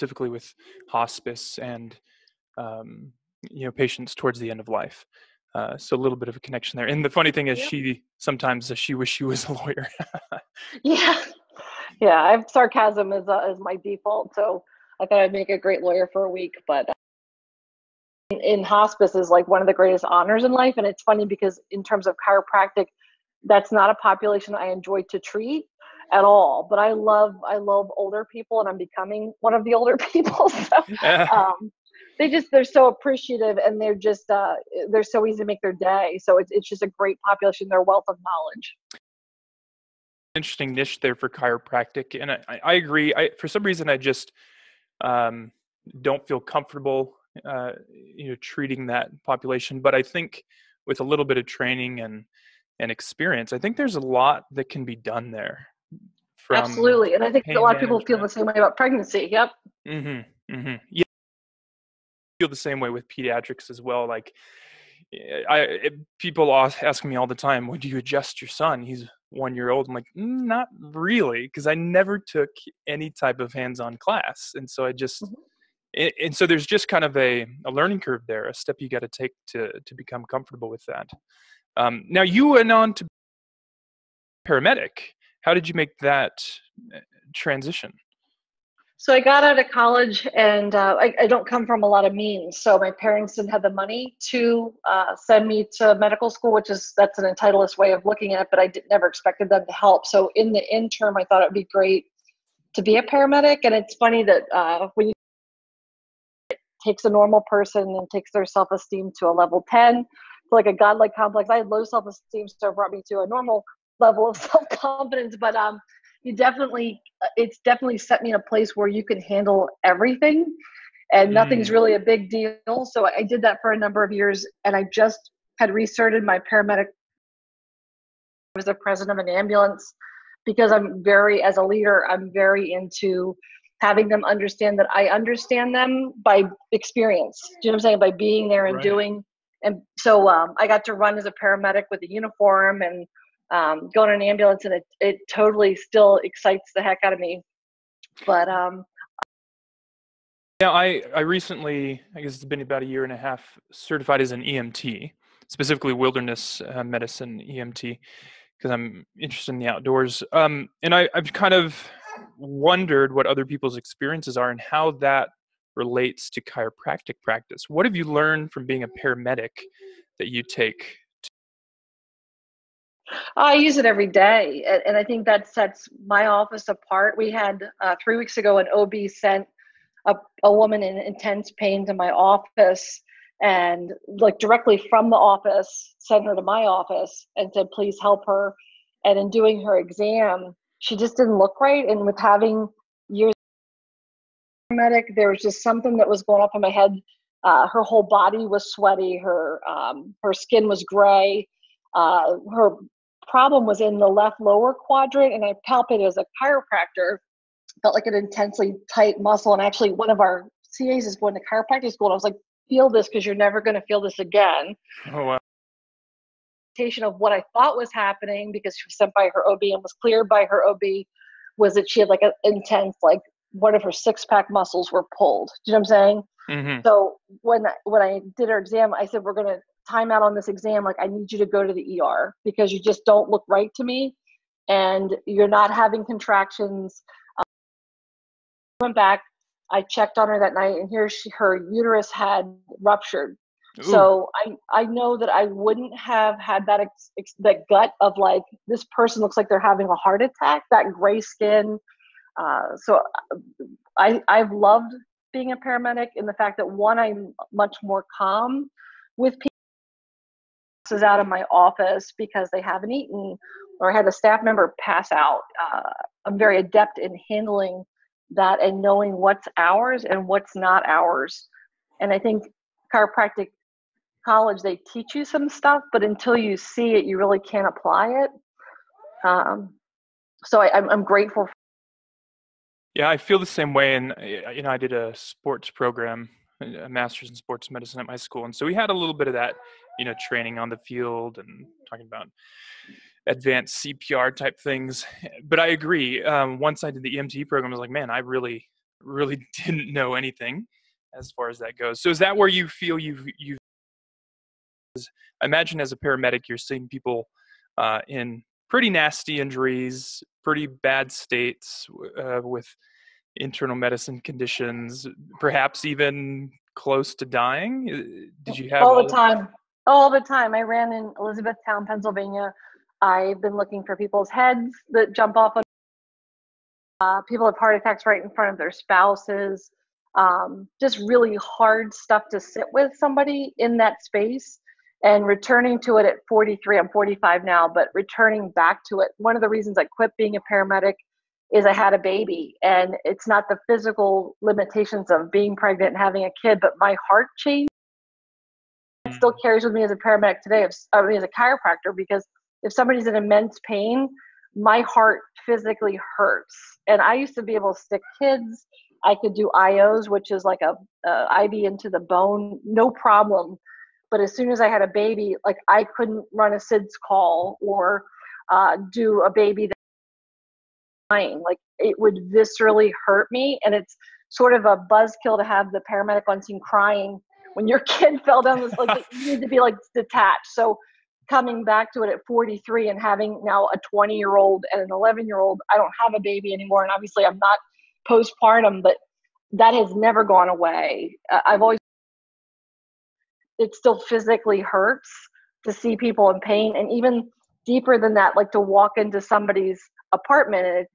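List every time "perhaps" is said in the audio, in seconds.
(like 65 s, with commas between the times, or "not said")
315 s.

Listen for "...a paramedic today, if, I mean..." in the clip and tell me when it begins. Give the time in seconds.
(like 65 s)
349 s.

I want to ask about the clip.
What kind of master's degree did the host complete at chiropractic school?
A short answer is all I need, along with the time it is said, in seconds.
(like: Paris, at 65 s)
Sports medicine, at 287 s.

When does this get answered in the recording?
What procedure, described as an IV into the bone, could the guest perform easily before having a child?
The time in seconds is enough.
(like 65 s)
359 s.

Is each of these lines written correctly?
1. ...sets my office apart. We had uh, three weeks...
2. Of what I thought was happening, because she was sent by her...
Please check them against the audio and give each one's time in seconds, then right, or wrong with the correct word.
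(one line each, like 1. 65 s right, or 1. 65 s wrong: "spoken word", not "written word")
1. 175 s right
2. 216 s right.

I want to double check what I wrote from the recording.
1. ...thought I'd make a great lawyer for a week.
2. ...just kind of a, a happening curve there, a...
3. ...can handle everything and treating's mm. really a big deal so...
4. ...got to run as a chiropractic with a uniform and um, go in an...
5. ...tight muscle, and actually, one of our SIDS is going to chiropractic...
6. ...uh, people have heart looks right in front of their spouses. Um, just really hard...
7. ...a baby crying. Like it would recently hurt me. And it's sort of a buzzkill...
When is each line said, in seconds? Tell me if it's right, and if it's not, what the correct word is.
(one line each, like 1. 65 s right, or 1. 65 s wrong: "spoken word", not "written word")
1. 15 s right
2. 76 s wrong: "learning", not "happening"
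3. 119 s wrong: "nothing", not "treating"
4. 140 s wrong: "paramedic", not "chiropractic"
5. 208 s wrong: "CAs", not "SIDS"
6. 327 s wrong: "attacks", not "looks"
7. 369 s wrong: "viscerally", not "recently".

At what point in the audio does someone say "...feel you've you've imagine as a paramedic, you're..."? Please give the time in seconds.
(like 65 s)
302 s.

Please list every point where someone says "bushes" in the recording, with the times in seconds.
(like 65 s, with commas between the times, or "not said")
not said.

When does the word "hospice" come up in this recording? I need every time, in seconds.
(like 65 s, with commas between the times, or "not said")
0 s, 18 s.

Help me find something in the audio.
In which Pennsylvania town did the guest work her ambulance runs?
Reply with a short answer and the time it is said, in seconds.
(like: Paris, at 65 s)
Elizabethtown, at 321 s.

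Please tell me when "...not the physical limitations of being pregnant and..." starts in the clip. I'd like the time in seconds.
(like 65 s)
343 s.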